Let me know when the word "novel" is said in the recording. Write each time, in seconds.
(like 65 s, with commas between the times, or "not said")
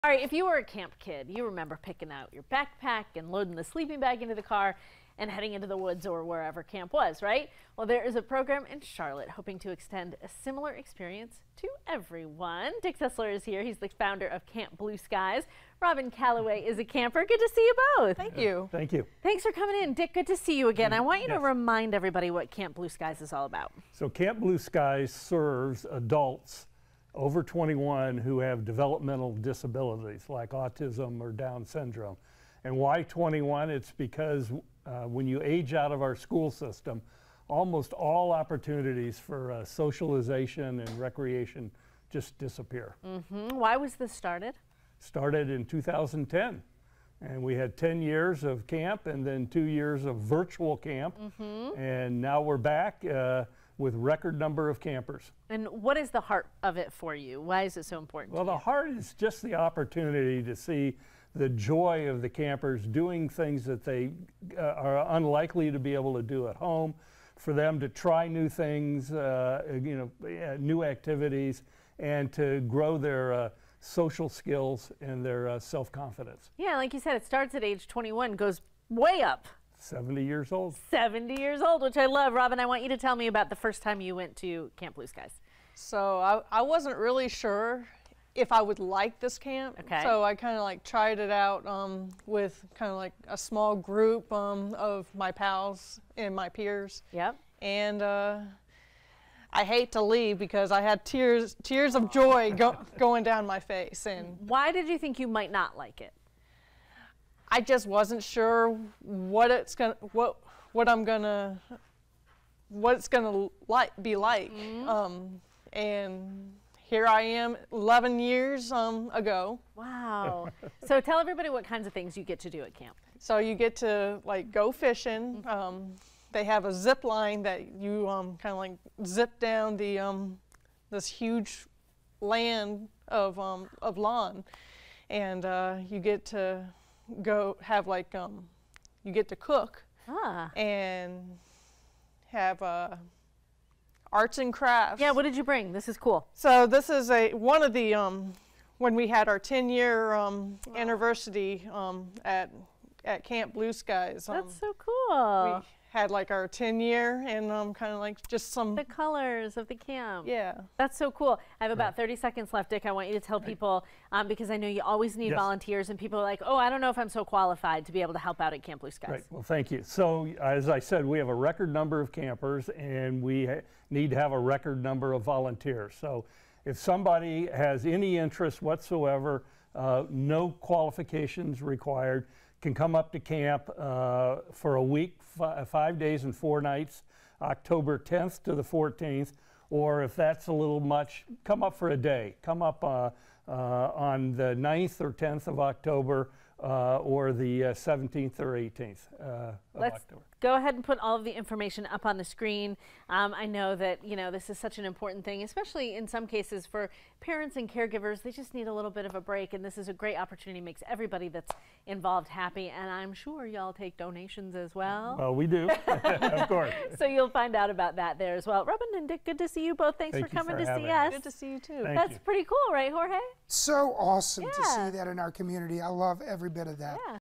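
not said.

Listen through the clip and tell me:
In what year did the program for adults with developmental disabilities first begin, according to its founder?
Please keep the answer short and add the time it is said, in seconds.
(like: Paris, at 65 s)
2010, at 45 s.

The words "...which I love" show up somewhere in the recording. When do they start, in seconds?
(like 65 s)
81 s.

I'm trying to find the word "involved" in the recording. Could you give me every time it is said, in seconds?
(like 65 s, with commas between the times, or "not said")
211 s.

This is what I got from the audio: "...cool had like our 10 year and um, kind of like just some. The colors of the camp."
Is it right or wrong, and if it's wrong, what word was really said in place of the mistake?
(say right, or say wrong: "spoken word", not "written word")
right.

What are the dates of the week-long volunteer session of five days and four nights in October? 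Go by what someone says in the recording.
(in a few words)
October 10th to 14th.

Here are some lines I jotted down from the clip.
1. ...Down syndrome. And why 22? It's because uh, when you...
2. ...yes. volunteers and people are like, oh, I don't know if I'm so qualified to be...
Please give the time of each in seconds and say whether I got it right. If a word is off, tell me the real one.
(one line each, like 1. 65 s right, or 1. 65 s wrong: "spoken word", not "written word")
1. 31 s wrong: "21", not "22"
2. 165 s right.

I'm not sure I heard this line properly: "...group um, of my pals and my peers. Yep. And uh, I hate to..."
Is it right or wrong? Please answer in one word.
right.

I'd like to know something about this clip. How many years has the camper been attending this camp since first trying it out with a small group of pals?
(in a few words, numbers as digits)
11.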